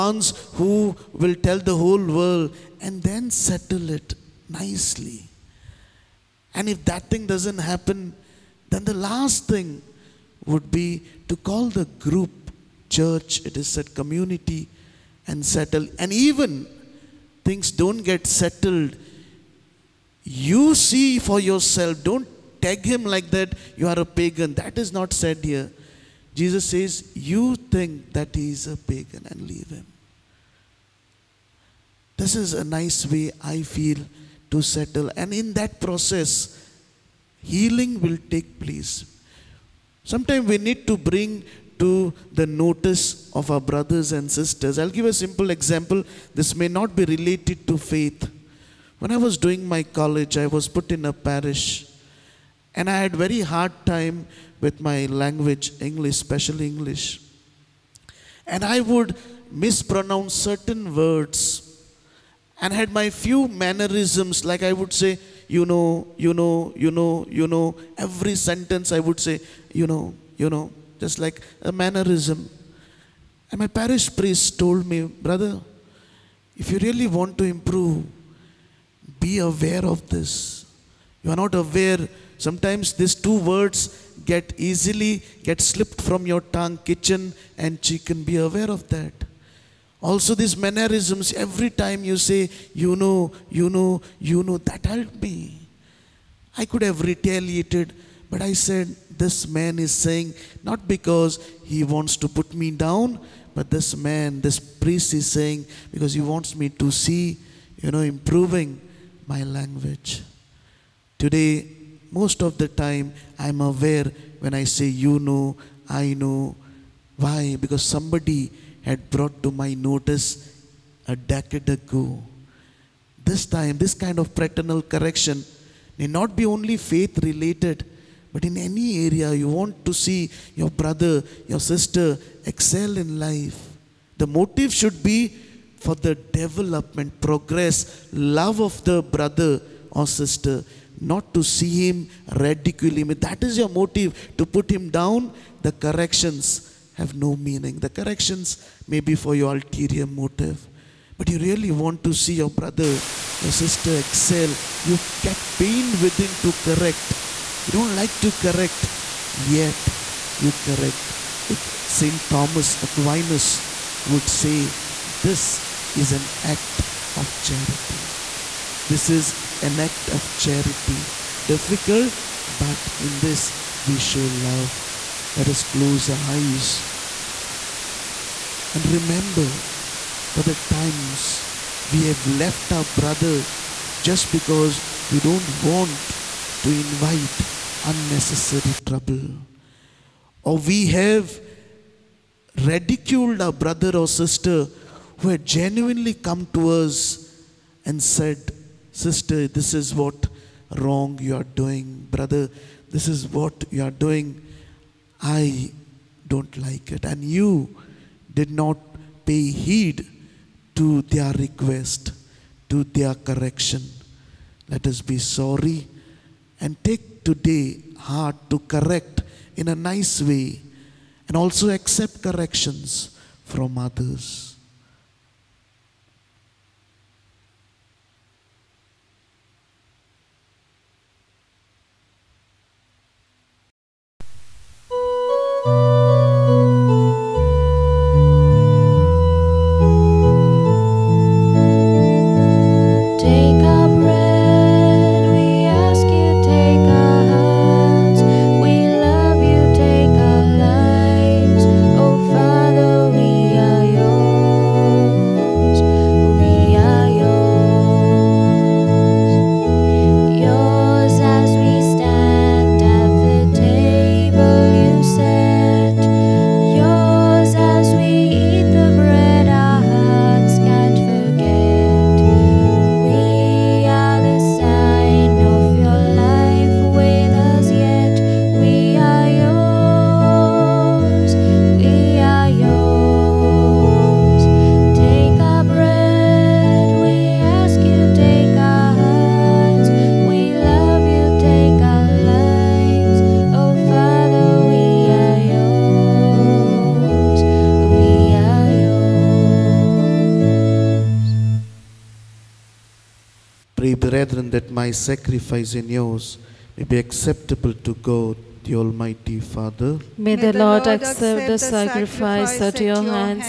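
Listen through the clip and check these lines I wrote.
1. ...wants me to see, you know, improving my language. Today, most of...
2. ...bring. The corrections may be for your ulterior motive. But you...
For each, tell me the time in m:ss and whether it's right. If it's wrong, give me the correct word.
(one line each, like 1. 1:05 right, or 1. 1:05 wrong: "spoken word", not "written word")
1. 1:46 right
2. 2:27 wrong: "meaning", not "bring".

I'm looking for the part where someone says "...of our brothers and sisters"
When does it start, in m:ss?
0:43.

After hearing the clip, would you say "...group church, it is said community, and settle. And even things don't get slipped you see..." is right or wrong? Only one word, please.
wrong.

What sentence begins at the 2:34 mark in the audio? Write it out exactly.
You get pain within to correct.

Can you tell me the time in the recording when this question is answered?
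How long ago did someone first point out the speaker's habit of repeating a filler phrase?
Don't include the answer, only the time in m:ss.
2:01.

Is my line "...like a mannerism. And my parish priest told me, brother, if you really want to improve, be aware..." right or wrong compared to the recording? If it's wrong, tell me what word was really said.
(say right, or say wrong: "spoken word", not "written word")
right.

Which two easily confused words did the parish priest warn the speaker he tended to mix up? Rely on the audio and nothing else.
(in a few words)
kitchen and chicken.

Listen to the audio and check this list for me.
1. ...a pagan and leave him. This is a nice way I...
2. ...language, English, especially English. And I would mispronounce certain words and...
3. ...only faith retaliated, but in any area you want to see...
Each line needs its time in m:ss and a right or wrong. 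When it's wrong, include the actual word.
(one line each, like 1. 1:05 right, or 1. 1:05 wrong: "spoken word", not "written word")
1. 0:28 right
2. 0:55 right
3. 2:06 wrong: "related", not "retaliated".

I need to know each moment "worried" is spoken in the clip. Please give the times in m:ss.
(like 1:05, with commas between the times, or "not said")
not said.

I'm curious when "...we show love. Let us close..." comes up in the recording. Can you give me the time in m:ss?
2:53.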